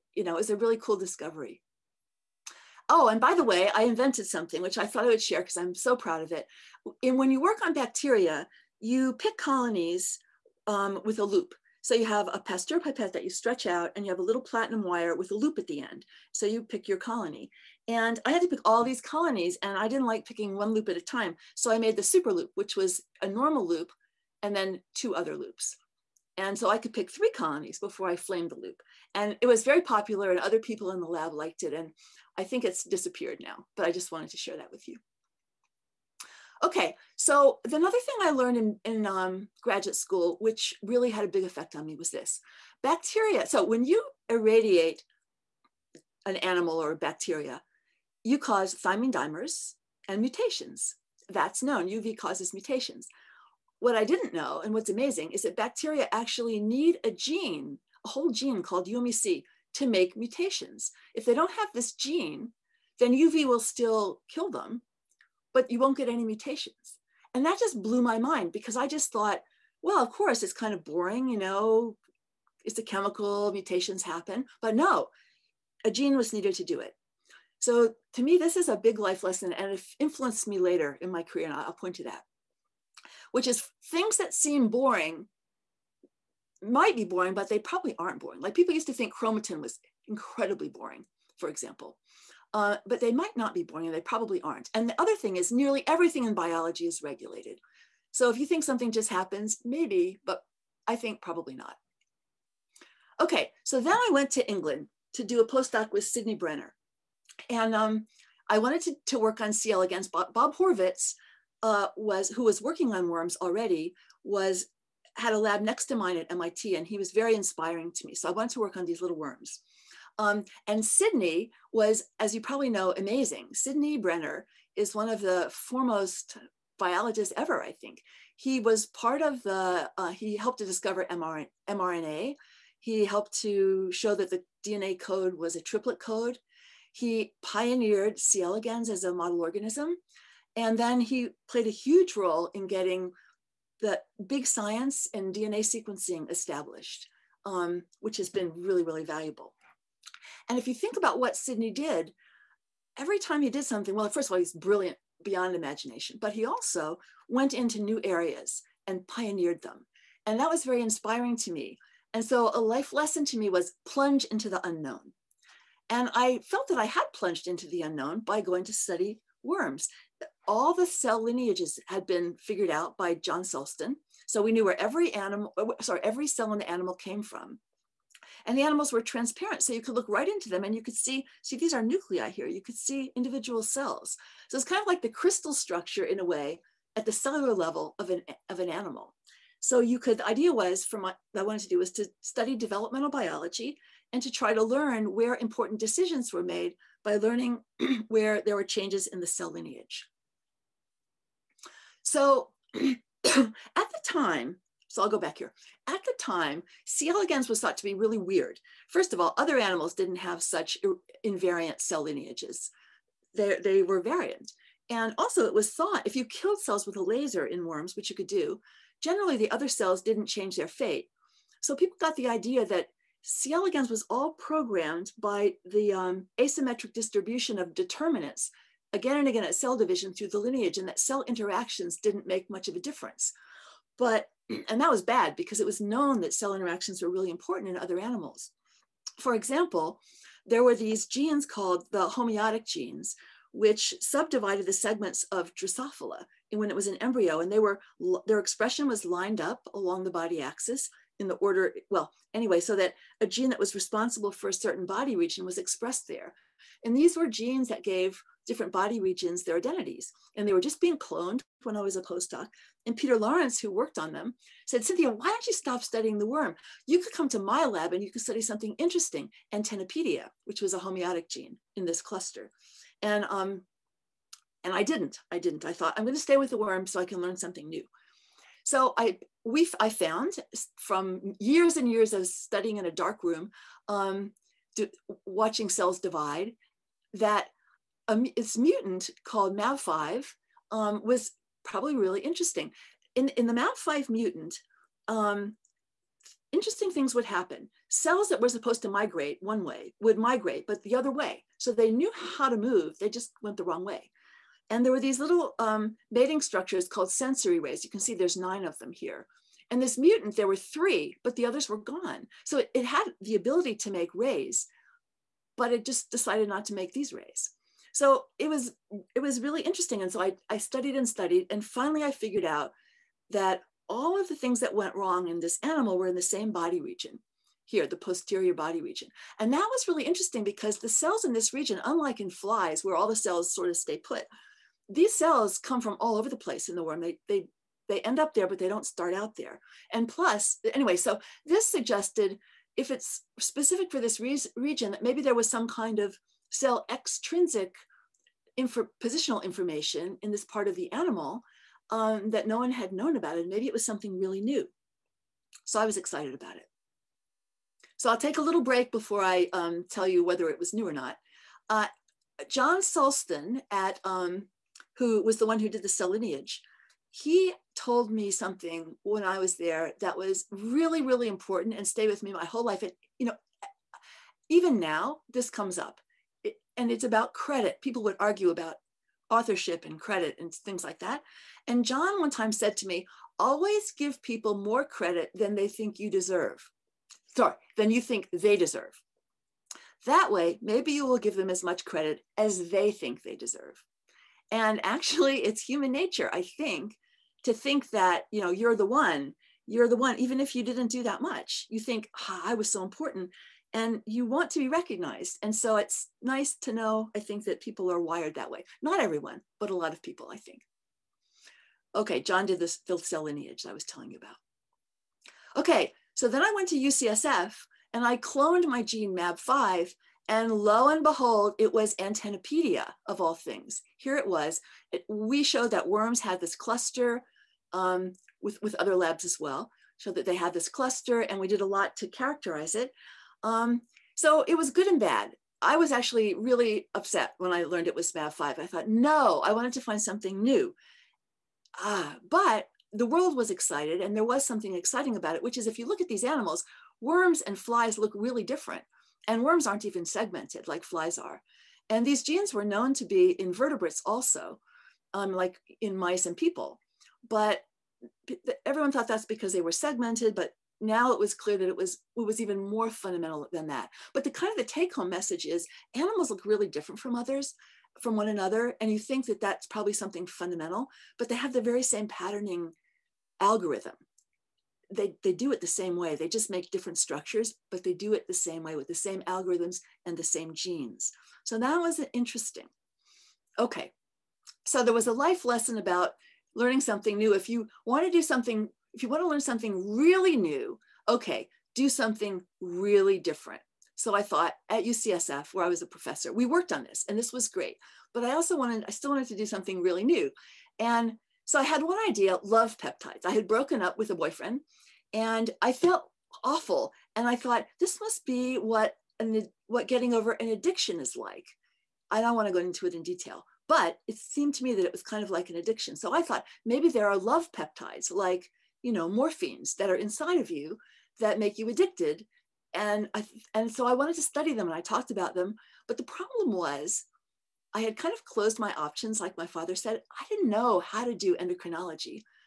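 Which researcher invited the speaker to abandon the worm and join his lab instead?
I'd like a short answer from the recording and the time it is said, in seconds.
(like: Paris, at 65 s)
Peter Lawrence, at 262 s.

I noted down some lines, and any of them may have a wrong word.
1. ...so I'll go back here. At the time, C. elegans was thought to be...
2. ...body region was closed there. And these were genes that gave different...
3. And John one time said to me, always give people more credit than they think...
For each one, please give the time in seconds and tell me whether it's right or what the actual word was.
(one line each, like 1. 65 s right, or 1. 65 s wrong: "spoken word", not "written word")
1. 204 s right
2. 254 s wrong: "expressed", not "closed"
3. 381 s right.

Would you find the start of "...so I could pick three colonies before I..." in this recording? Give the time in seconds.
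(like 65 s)
26 s.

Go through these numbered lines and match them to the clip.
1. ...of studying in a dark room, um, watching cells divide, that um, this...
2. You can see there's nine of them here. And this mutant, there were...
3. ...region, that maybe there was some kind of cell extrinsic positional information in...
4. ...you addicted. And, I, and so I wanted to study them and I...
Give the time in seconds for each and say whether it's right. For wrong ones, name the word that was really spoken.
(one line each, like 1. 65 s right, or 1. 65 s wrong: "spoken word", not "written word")
1. 282 s right
2. 307 s right
3. 344 s right
4. 521 s right.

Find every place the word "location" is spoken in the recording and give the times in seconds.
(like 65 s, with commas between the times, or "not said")
not said.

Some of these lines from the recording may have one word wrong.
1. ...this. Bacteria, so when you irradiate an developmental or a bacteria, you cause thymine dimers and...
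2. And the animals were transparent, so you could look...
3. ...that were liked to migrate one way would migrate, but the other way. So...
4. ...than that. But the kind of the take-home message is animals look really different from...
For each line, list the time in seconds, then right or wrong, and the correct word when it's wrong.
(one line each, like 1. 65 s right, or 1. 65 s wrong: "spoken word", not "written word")
1. 42 s wrong: "animal", not "developmental"
2. 178 s right
3. 298 s wrong: "supposed", not "liked"
4. 463 s right.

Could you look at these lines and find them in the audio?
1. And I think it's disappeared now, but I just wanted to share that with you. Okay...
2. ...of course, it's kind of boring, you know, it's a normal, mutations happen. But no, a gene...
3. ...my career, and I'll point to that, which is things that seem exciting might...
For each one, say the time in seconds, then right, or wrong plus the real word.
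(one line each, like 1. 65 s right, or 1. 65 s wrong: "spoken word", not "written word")
1. 31 s right
2. 70 s wrong: "chemical", not "normal"
3. 81 s wrong: "boring", not "exciting".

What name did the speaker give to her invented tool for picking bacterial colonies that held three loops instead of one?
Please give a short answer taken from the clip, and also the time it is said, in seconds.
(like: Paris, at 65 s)
super loop, at 22 s.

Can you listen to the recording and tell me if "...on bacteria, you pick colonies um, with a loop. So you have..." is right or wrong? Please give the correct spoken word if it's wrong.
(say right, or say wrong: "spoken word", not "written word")
right.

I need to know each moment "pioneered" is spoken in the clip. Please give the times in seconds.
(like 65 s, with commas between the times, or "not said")
137 s, 159 s.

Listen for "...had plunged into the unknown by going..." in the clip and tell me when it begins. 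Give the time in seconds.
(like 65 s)
166 s.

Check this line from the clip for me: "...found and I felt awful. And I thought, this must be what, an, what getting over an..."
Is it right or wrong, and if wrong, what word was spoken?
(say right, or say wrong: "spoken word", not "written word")
wrong: "boyfriend", not "found".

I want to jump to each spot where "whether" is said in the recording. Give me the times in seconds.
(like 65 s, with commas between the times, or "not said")
360 s.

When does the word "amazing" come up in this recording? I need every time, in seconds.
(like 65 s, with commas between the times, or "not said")
54 s, 122 s.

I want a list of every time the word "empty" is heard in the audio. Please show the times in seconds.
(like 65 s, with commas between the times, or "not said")
not said.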